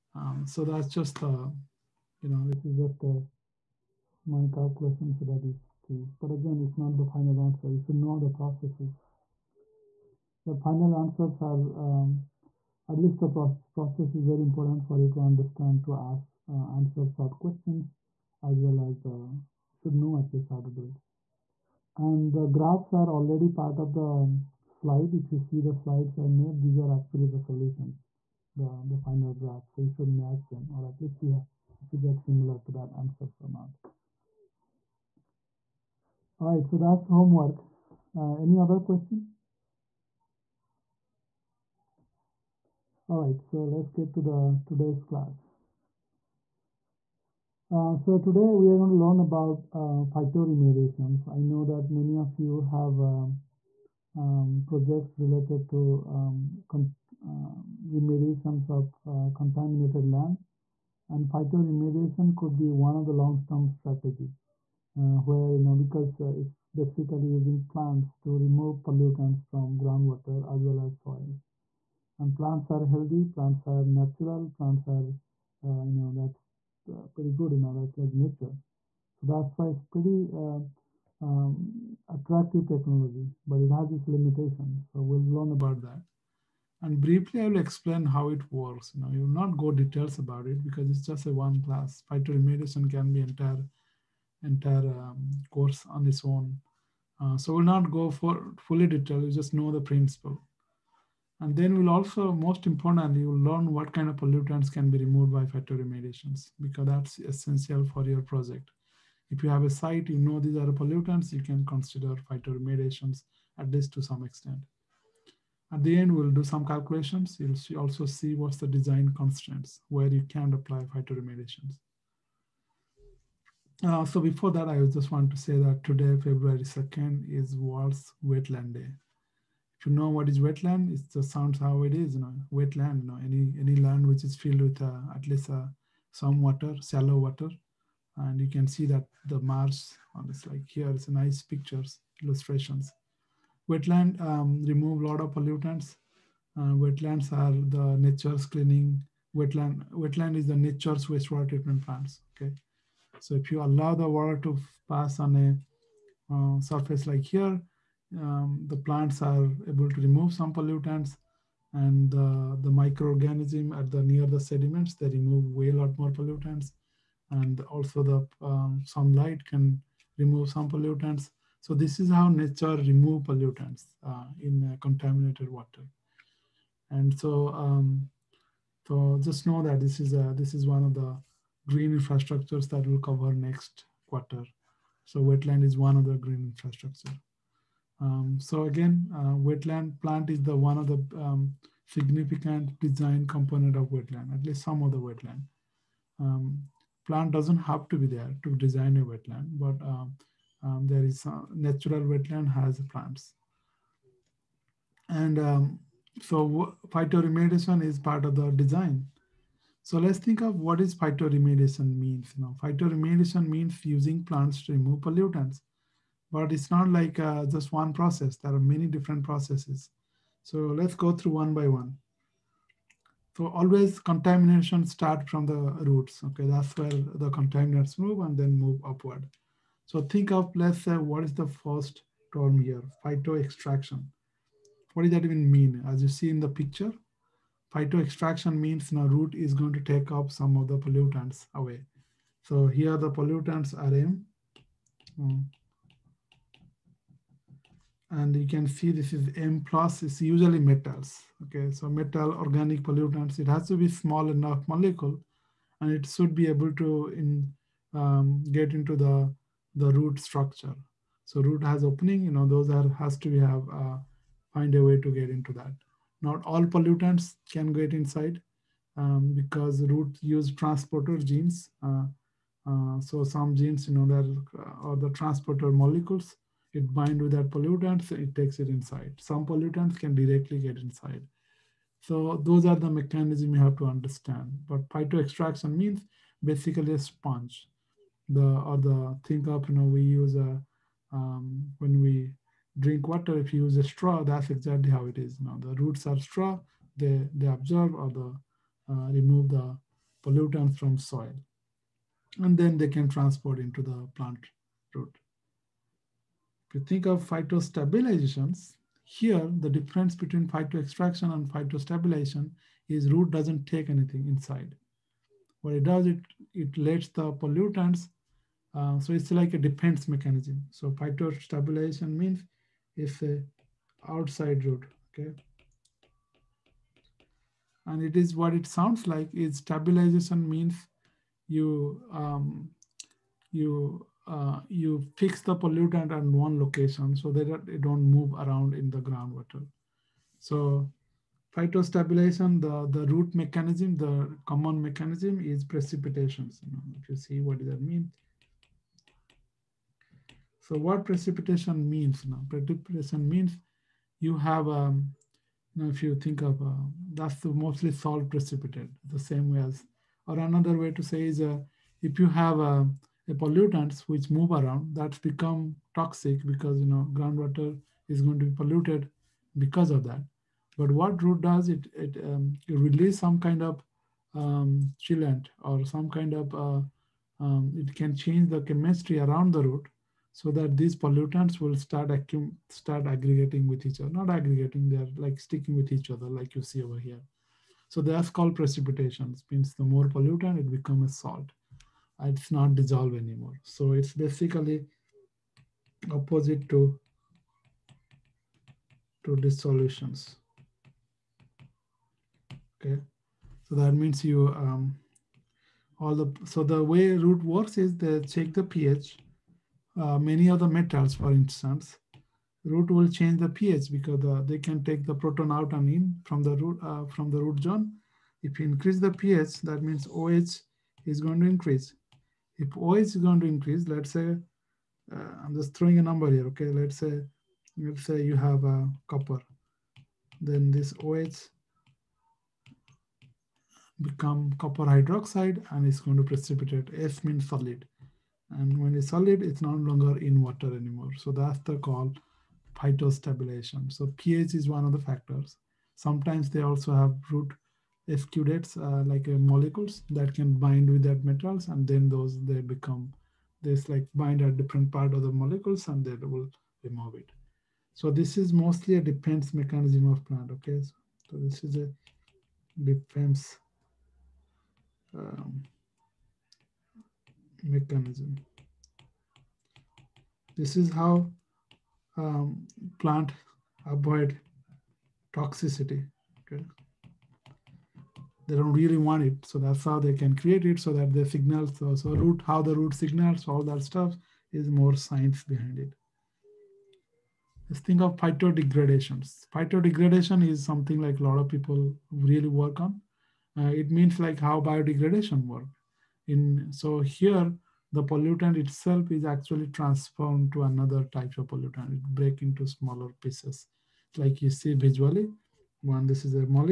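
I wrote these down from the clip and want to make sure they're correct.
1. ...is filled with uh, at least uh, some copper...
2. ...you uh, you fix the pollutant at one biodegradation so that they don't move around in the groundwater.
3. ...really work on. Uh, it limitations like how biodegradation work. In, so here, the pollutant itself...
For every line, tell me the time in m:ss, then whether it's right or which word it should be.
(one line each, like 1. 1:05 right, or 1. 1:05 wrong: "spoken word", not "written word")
1. 2:14 wrong: "water", not "copper"
2. 5:33 wrong: "location", not "biodegradation"
3. 8:12 wrong: "means", not "limitations".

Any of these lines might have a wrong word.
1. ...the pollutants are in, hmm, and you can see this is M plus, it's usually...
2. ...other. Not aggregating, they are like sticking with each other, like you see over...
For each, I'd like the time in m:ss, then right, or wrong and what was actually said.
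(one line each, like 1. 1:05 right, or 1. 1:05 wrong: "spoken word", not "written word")
1. 4:02 right
2. 6:23 right.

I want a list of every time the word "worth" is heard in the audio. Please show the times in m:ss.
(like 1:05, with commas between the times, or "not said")
not said.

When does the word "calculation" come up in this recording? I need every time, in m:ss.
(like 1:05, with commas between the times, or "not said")
0:04, 1:56.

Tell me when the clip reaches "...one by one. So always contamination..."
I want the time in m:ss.
3:41.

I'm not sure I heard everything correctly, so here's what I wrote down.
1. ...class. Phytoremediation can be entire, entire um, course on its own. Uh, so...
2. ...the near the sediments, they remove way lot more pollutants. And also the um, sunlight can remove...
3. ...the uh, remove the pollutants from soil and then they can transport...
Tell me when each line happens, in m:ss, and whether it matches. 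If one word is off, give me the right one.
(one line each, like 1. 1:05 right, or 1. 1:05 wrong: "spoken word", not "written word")
1. 1:31 right
2. 2:43 right
3. 4:58 right.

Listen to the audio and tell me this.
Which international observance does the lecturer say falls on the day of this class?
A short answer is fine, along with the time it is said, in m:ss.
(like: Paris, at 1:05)
World's Wetland Day, at 2:07.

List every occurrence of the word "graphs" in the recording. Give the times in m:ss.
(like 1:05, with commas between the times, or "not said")
0:22, 0:29.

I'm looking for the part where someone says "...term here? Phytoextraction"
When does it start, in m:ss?
3:52.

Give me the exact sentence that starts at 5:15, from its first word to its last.
What it does, it, it lets the pollutants, uh, so it's like a defense mechanism.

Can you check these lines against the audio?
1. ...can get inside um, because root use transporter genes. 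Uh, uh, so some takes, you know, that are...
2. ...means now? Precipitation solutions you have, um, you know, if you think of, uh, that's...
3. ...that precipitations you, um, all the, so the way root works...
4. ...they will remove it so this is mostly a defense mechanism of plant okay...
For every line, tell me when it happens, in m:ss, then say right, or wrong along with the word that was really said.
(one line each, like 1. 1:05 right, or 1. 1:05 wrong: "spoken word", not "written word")
1. 4:27 wrong: "genes", not "takes"
2. 5:51 wrong: "means", not "solutions"
3. 6:43 wrong: "means", not "precipitations"
4. 7:36 right.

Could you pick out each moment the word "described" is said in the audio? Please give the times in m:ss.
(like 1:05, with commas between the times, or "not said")
not said.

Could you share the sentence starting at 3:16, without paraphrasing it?
Um, plant doesn't have to be there to design a wetland, but um, um, there is natural wetland has plants.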